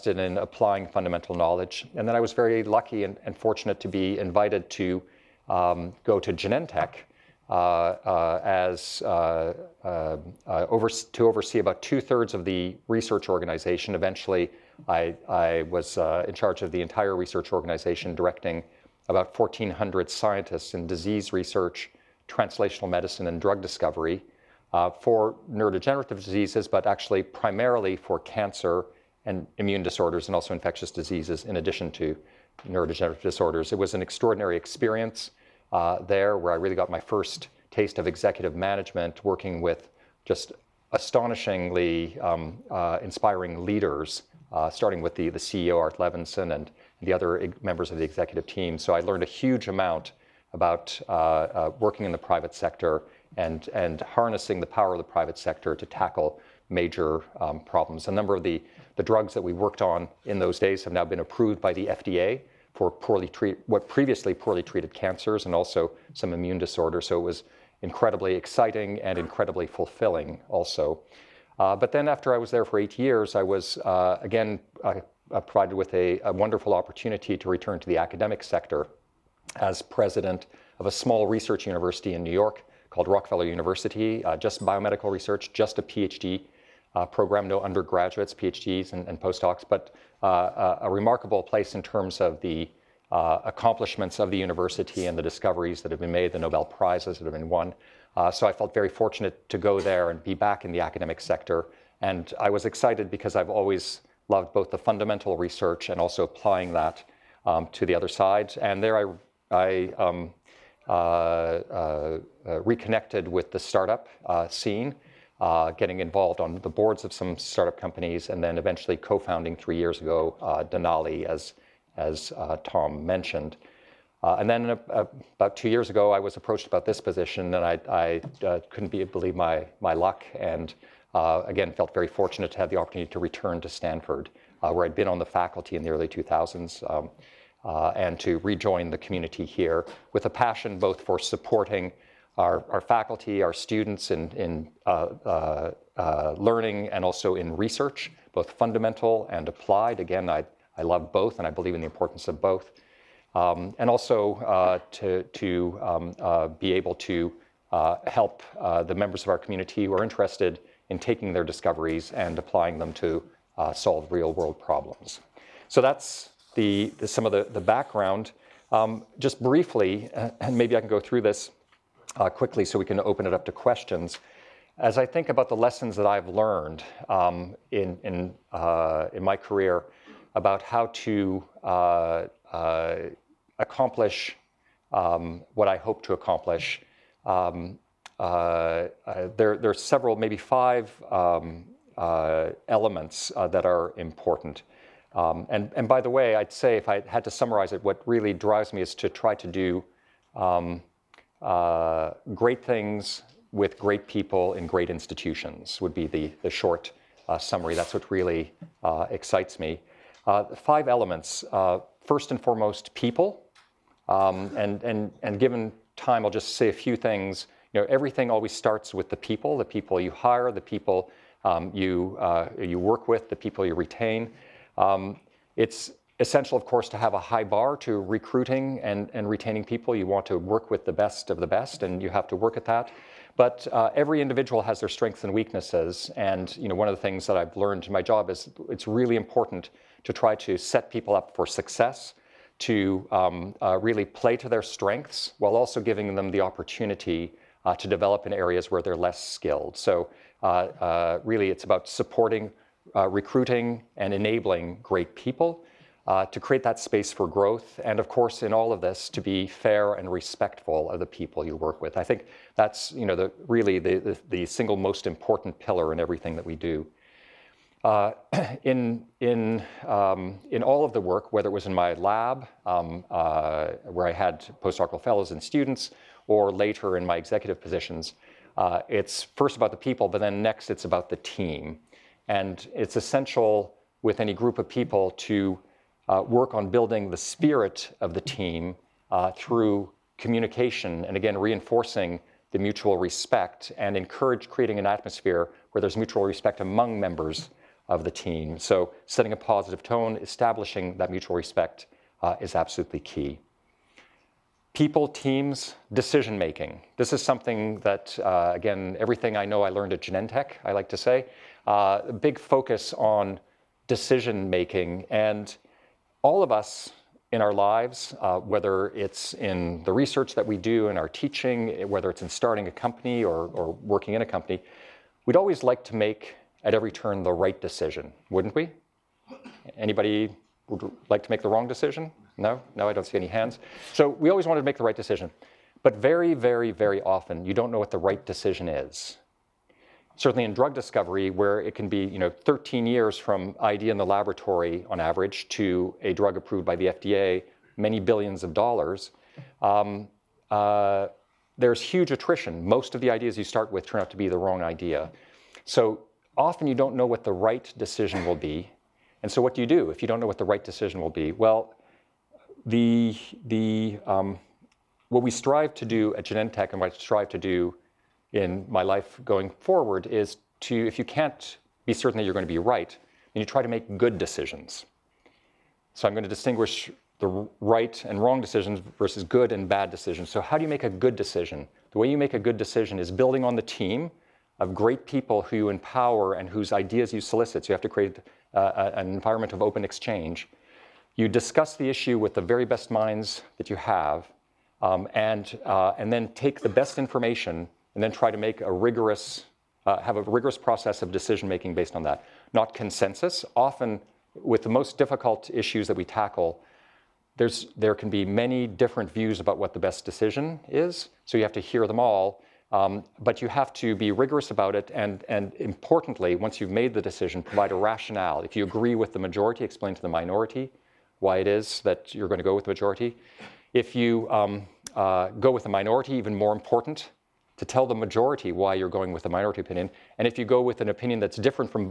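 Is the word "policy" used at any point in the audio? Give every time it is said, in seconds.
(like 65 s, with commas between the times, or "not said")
not said.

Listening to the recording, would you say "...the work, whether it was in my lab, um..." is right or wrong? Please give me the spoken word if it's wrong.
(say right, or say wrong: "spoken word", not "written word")
right.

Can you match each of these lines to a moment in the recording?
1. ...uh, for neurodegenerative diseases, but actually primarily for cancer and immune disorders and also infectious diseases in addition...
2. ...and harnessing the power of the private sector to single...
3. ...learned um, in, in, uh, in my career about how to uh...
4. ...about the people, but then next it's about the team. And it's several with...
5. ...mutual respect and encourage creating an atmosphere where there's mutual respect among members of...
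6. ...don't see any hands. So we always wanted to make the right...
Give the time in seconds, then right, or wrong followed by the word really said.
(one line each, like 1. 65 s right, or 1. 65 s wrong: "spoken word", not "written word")
1. 24 s right
2. 53 s wrong: "tackle", not "single"
3. 176 s right
4. 279 s wrong: "essential", not "several"
5. 292 s right
6. 332 s right.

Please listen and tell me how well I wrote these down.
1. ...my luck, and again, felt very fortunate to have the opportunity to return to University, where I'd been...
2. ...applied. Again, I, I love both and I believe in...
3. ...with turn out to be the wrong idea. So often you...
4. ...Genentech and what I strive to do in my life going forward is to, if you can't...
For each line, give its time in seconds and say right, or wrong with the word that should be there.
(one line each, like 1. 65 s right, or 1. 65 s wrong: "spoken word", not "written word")
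1. 129 s wrong: "Stanford", not "University"
2. 149 s right
3. 353 s right
4. 366 s right.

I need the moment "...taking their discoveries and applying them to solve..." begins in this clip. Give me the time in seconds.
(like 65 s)
160 s.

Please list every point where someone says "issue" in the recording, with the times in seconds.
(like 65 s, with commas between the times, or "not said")
391 s, 405 s.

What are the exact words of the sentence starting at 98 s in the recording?
so I felt very fortunate to go there and be back in the academic sector.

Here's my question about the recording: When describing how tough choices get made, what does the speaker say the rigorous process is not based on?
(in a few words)
Consensus.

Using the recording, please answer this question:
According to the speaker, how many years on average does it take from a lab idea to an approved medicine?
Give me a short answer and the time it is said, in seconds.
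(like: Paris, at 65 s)
13, at 342 s.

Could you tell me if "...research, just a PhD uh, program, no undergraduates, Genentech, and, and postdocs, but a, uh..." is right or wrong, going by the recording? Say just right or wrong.
wrong.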